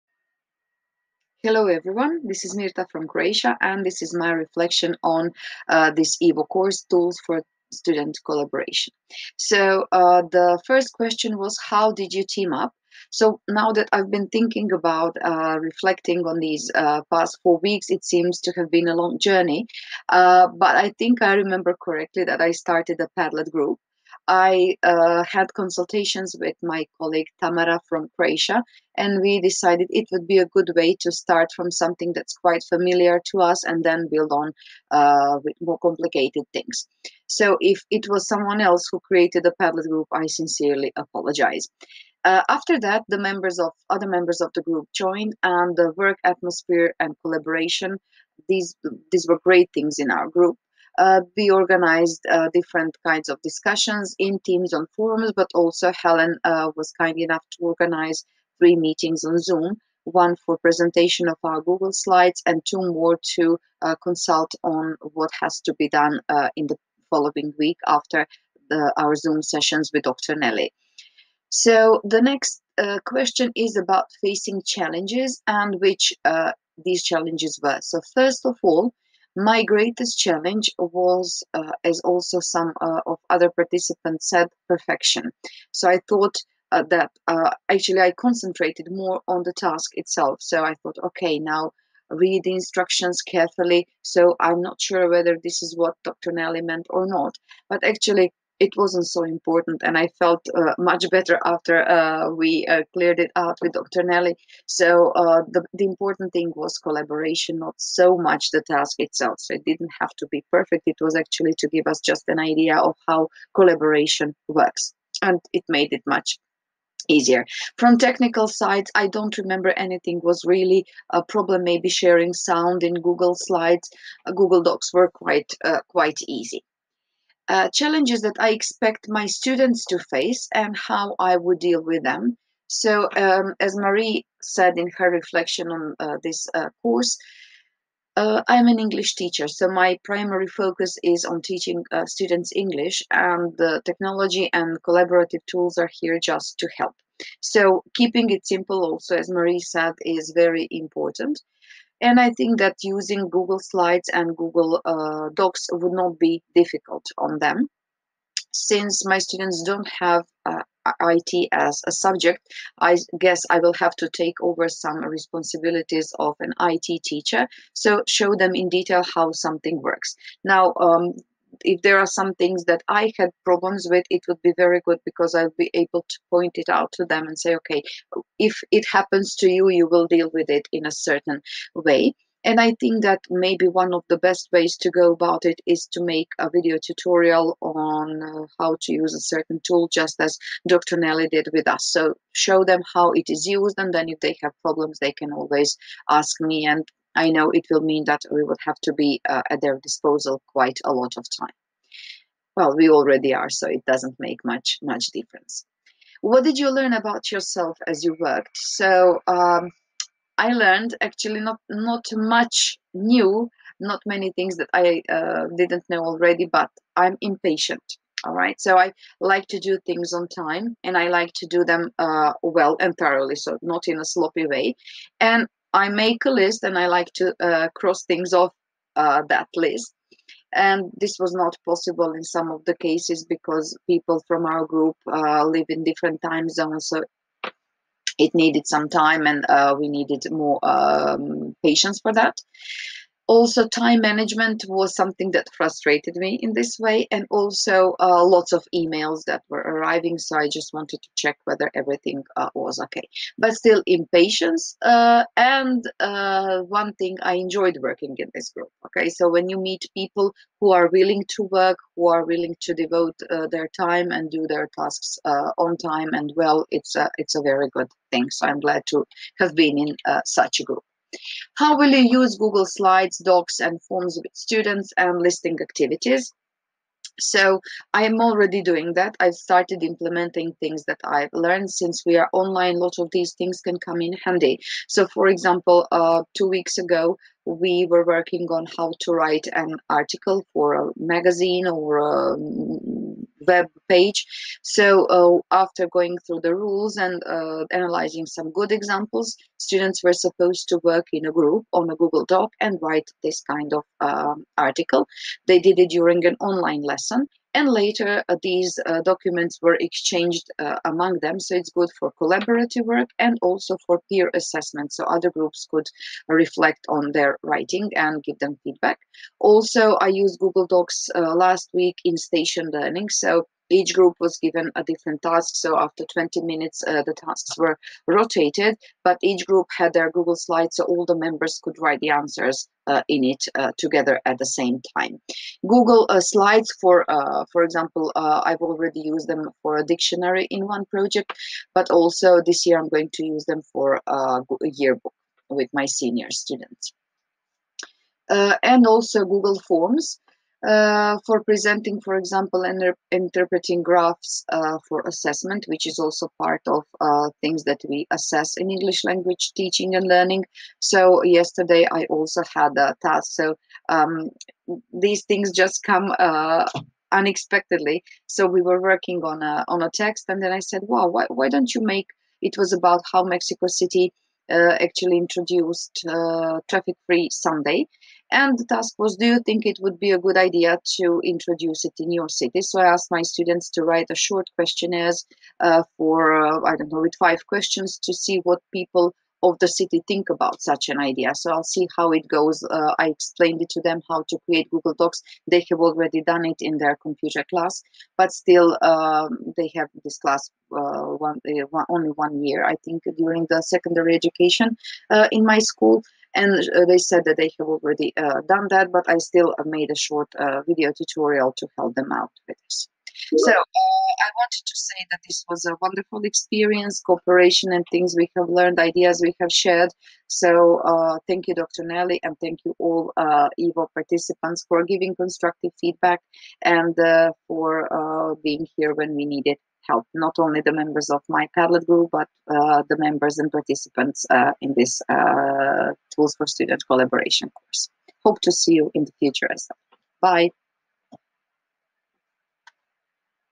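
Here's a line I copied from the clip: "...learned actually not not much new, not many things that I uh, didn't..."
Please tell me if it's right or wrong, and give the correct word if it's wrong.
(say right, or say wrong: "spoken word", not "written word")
right.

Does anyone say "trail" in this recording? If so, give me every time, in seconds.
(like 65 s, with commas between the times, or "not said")
not said.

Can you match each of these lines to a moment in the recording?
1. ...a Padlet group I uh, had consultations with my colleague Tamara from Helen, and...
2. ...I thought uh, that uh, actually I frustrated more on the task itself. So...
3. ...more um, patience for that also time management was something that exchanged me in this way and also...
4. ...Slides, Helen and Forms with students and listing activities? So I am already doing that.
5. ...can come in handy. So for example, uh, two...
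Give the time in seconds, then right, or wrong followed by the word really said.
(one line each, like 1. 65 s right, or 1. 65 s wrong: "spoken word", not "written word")
1. 23 s wrong: "Croatia", not "Helen"
2. 85 s wrong: "concentrated", not "frustrated"
3. 240 s wrong: "frustrated", not "exchanged"
4. 272 s wrong: "Docs", not "Helen"
5. 283 s right.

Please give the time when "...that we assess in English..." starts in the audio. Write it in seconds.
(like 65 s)
357 s.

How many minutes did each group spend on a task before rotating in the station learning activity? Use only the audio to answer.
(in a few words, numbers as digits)
20.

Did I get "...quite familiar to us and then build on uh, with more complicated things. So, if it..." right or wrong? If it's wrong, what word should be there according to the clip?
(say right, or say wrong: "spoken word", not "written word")
right.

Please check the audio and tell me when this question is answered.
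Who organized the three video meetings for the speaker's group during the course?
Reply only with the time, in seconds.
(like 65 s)
55 s.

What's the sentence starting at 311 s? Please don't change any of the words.
So it's good for collaborative work and also for peer assessment.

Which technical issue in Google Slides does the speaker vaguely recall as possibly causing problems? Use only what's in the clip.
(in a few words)
Sharing sound.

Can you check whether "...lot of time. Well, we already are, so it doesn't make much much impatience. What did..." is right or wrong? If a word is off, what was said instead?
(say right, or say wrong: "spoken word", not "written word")
wrong: "difference", not "impatience".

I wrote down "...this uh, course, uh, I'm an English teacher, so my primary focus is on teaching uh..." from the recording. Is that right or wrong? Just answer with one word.
right.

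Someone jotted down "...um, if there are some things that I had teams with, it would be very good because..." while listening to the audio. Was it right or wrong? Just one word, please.
wrong.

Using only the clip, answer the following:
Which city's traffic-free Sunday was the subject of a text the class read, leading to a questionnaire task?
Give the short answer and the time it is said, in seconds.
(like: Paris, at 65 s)
Mexico City, at 373 s.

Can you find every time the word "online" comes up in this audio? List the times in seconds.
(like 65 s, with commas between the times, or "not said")
282 s, 306 s.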